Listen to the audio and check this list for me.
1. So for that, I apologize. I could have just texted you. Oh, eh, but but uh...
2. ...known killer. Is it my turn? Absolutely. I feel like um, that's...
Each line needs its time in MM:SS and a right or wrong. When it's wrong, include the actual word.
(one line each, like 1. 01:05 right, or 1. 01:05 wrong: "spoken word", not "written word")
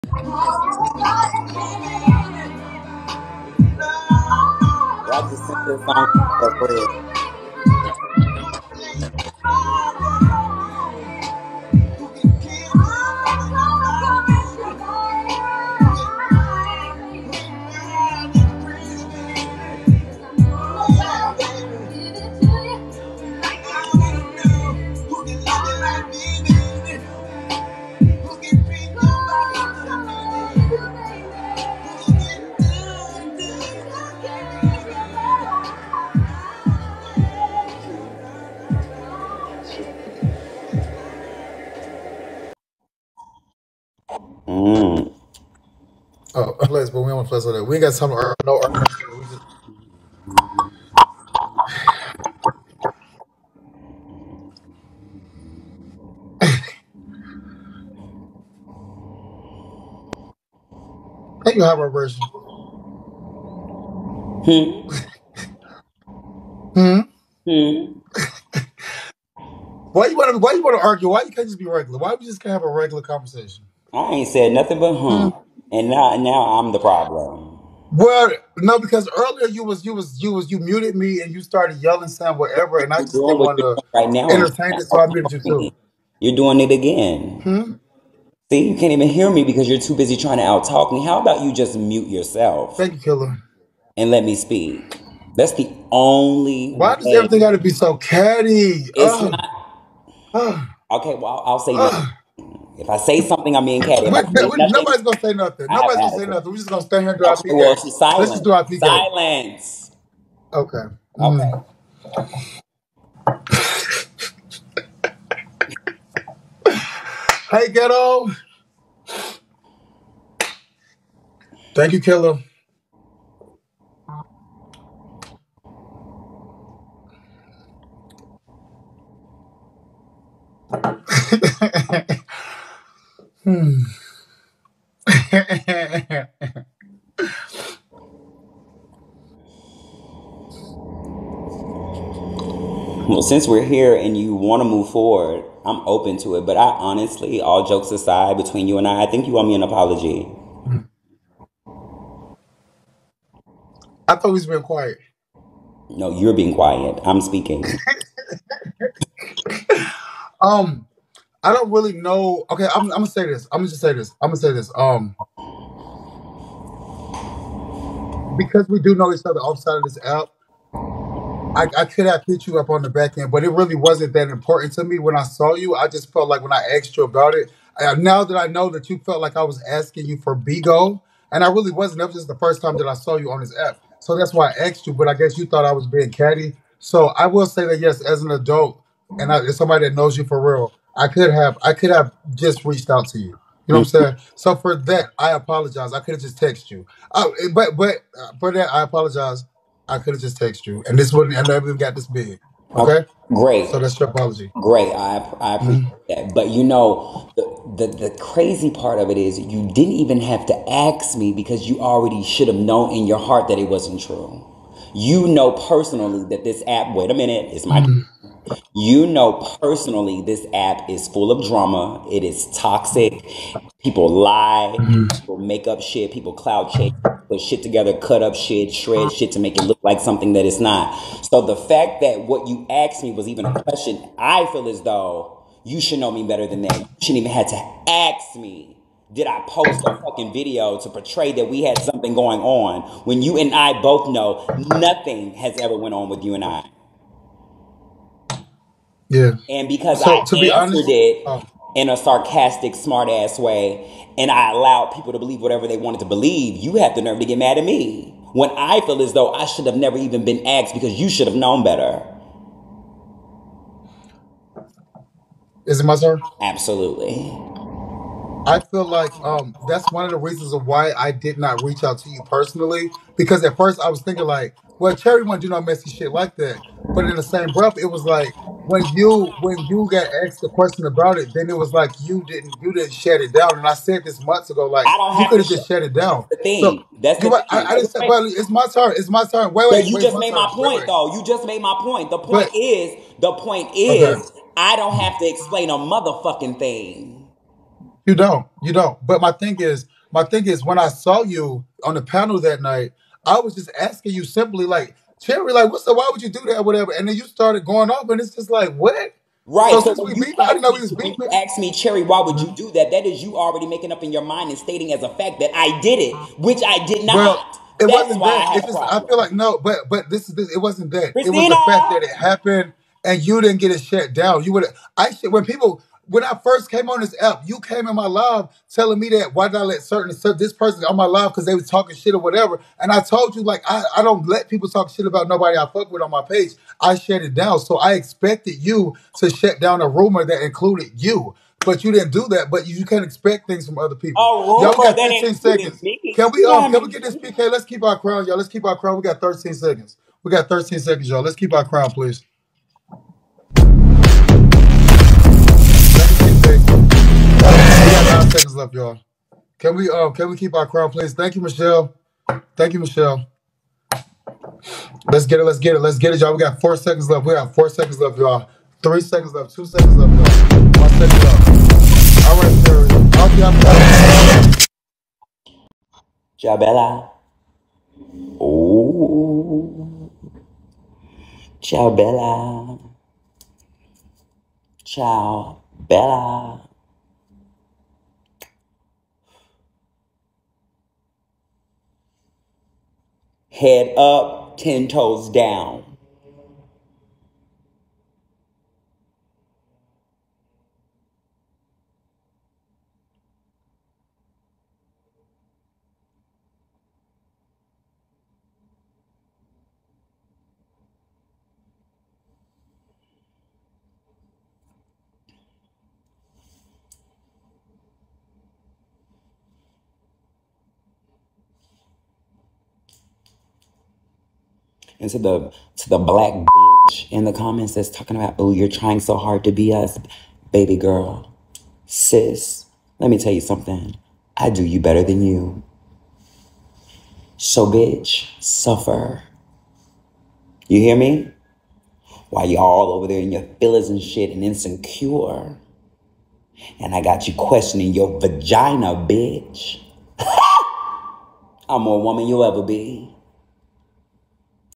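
1. 03:14 right
2. 04:21 wrong: "better", not "killer".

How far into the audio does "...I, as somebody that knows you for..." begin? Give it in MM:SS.
03:09.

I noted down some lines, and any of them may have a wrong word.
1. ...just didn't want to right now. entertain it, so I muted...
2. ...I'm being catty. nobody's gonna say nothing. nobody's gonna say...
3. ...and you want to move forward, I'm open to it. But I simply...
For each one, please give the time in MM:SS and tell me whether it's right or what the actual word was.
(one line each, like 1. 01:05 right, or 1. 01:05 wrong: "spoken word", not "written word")
1. 01:23 right
2. 01:43 right
3. 02:23 wrong: "honestly", not "simply".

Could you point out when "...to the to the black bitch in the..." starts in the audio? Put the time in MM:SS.
07:05.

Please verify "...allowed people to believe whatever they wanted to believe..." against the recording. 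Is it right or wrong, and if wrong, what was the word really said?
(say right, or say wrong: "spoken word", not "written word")
right.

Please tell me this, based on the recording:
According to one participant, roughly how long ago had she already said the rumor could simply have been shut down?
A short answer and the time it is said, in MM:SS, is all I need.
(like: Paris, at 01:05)
months ago, at 04:44.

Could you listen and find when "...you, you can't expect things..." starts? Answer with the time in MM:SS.
05:42.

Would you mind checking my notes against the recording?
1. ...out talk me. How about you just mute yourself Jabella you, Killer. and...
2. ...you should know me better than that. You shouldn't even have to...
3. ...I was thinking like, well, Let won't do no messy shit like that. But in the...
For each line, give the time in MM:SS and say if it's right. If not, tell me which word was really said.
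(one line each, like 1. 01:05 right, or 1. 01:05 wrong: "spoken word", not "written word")
1. 01:30 wrong: "Thank", not "Jabella"
2. 03:55 right
3. 04:33 wrong: "Cherry", not "Let".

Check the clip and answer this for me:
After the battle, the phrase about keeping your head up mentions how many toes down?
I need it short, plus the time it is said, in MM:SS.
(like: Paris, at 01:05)
10, at 06:34.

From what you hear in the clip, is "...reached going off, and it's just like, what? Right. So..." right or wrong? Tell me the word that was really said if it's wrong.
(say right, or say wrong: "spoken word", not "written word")
wrong: "started", not "reached".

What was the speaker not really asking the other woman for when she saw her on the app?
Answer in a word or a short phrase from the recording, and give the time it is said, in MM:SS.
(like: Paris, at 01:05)
Bigo, at 03:00.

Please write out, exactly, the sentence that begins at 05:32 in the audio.
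And I told you like I, I don't let people talk shit about nobody I fuck with on my page.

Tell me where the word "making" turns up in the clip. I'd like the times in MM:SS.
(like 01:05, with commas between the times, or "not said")
05:13.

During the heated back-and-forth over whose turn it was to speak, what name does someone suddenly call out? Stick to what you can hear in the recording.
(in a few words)
Christina.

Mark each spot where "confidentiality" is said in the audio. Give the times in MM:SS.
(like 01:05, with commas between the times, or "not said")
not said.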